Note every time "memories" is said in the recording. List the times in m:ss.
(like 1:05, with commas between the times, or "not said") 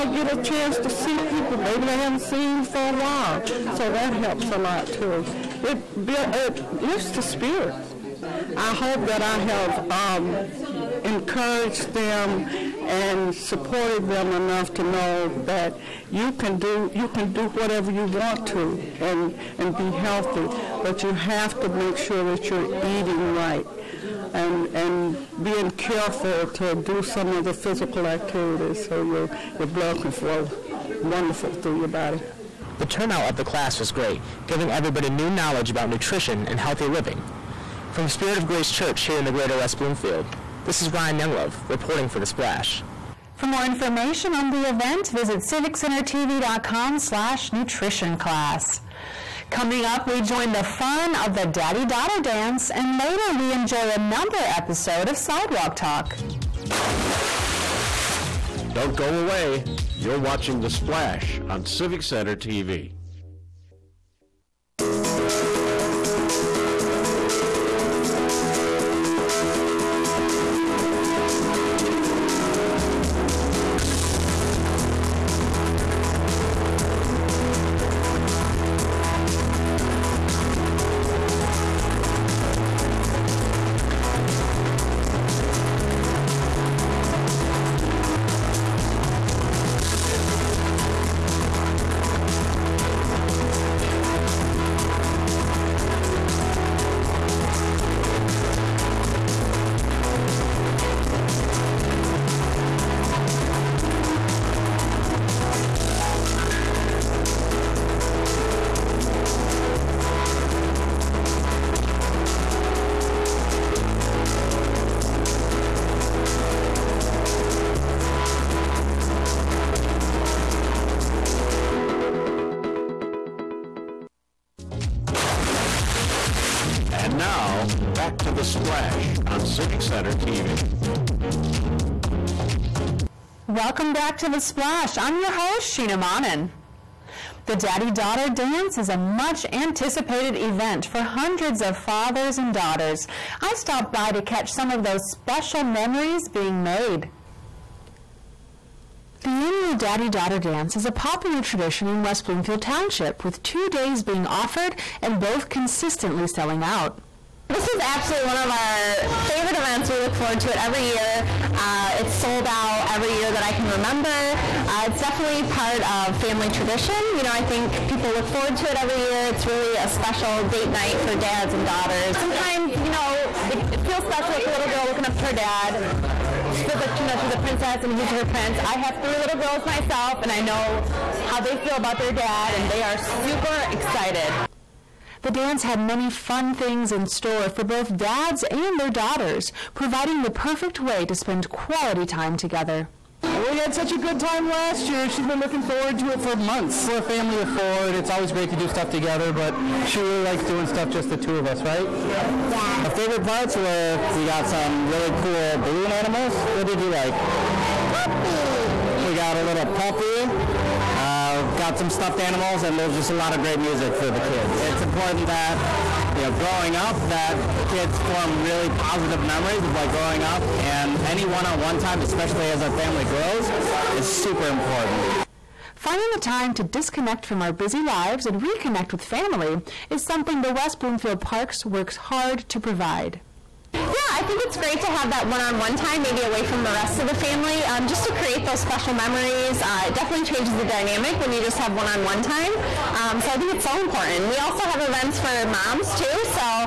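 2:25, 3:39, 3:58.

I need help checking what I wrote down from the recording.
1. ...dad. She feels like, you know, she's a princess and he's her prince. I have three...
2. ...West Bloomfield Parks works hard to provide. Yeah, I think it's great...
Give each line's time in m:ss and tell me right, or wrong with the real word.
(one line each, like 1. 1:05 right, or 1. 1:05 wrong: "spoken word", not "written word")
1. 2:55 right
2. 3:50 right.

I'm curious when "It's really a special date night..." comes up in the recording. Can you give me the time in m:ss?
2:49.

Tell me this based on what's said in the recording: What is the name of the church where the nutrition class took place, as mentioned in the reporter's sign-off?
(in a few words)
Spirit of Grace Church.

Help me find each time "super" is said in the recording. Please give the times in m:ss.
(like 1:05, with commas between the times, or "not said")
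3:03, 3:44.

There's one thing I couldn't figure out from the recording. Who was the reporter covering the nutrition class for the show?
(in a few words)
Ryan Younglove.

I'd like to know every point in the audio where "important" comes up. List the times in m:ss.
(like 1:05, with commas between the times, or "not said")
3:34, 3:44, 4:03.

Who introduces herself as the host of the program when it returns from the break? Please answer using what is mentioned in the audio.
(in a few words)
Sheena Monnin.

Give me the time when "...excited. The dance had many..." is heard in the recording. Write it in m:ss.
3:03.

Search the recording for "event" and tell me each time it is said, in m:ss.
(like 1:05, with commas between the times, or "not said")
0:44, 2:20, 2:39, 4:04.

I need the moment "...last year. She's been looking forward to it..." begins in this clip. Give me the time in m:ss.
3:14.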